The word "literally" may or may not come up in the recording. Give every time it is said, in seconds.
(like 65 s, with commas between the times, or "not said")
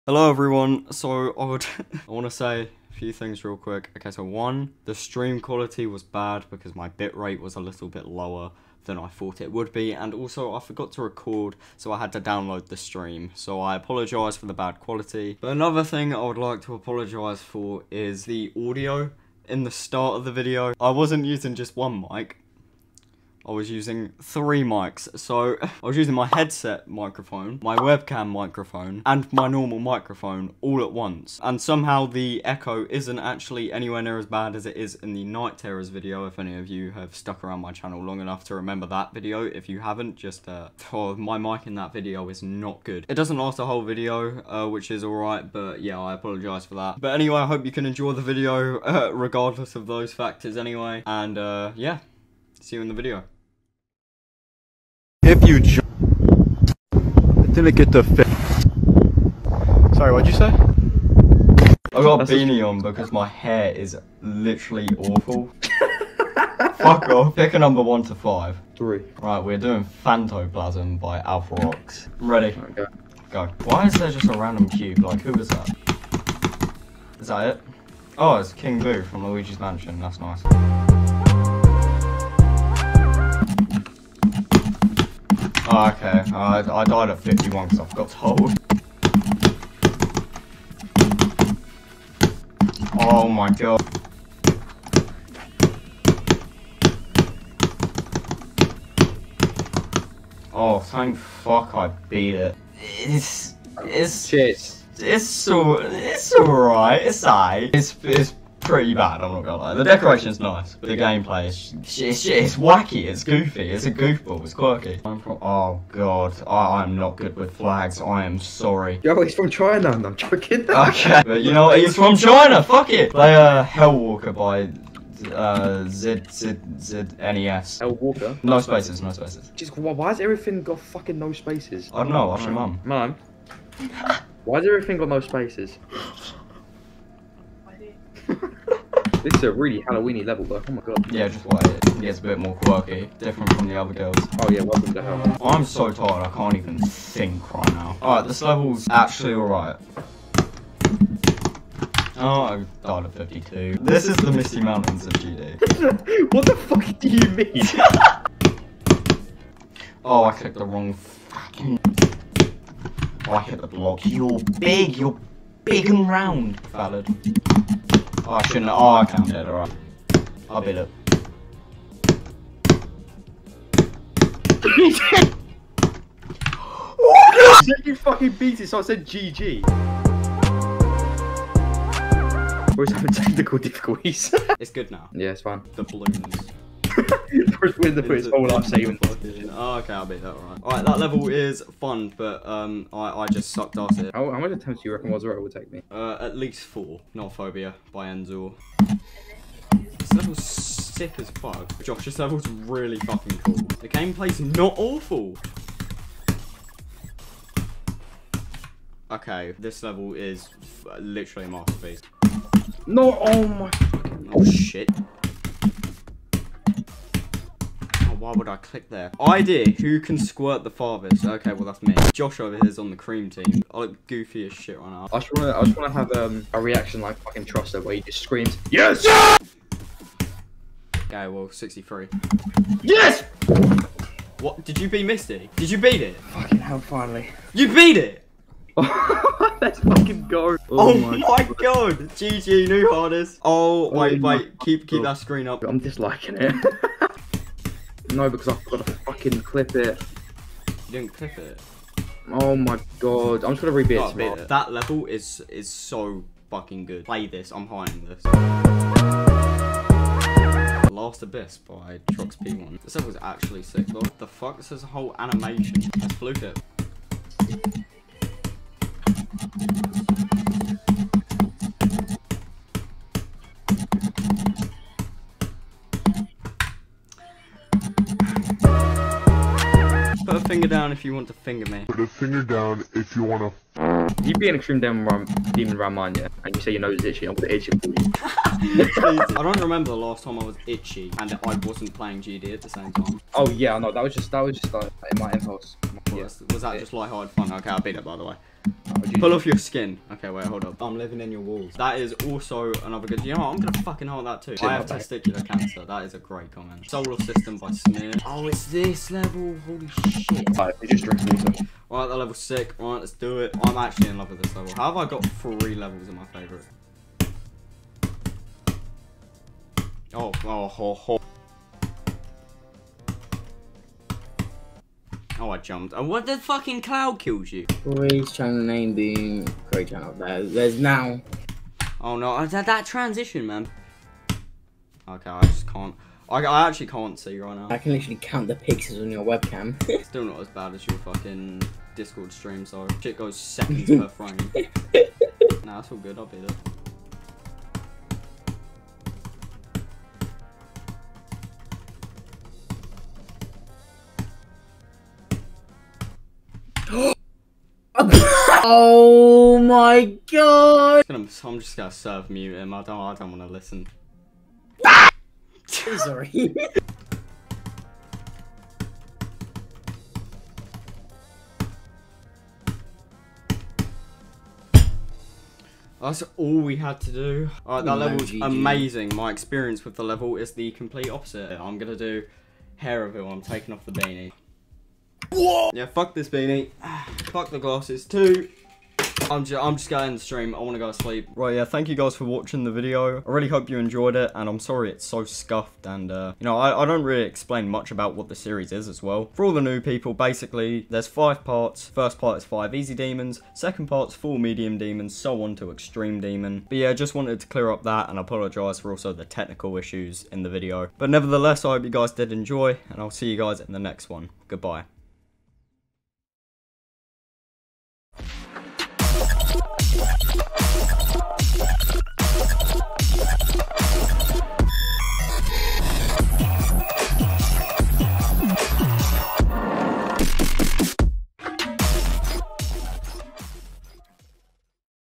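64 s, 210 s, 337 s.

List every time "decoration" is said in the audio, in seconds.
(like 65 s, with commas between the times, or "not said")
109 s.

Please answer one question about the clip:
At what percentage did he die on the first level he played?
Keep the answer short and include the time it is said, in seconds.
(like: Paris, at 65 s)
51, at 87 s.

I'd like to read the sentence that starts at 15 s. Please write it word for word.
But another thing I would like to apologise for is the audio in the start of the video.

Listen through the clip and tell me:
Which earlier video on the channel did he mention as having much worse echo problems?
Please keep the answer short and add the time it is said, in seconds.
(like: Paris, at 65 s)
Night Terrors, at 35 s.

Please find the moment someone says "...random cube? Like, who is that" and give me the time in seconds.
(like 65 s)
74 s.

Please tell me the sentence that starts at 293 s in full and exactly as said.
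Oh yeah, no, that was just that was just like my impulse.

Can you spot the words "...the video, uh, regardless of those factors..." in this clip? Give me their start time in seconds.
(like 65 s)
48 s.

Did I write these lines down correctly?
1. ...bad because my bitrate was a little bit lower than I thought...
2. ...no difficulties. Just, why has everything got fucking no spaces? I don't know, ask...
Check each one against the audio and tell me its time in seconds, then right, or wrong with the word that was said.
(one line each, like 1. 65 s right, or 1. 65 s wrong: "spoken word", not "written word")
1. 6 s right
2. 129 s wrong: "spaces", not "difficulties".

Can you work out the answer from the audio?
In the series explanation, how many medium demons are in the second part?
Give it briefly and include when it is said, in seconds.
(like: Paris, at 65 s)
4, at 404 s.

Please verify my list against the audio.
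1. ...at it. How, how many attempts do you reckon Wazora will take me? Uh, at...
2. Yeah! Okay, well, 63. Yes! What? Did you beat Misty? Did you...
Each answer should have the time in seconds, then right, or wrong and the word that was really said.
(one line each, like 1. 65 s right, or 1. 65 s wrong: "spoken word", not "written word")
1. 193 s right
2. 229 s right.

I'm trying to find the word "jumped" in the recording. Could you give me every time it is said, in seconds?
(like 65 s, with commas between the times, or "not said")
325 s.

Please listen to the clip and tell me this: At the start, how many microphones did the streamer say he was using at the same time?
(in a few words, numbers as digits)
3.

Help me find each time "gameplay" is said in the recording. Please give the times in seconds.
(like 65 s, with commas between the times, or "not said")
110 s, 203 s.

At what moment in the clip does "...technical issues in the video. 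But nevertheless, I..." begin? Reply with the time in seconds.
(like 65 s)
409 s.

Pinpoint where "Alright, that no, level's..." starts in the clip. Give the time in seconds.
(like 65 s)
377 s.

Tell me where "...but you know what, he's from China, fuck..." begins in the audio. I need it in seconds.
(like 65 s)
121 s.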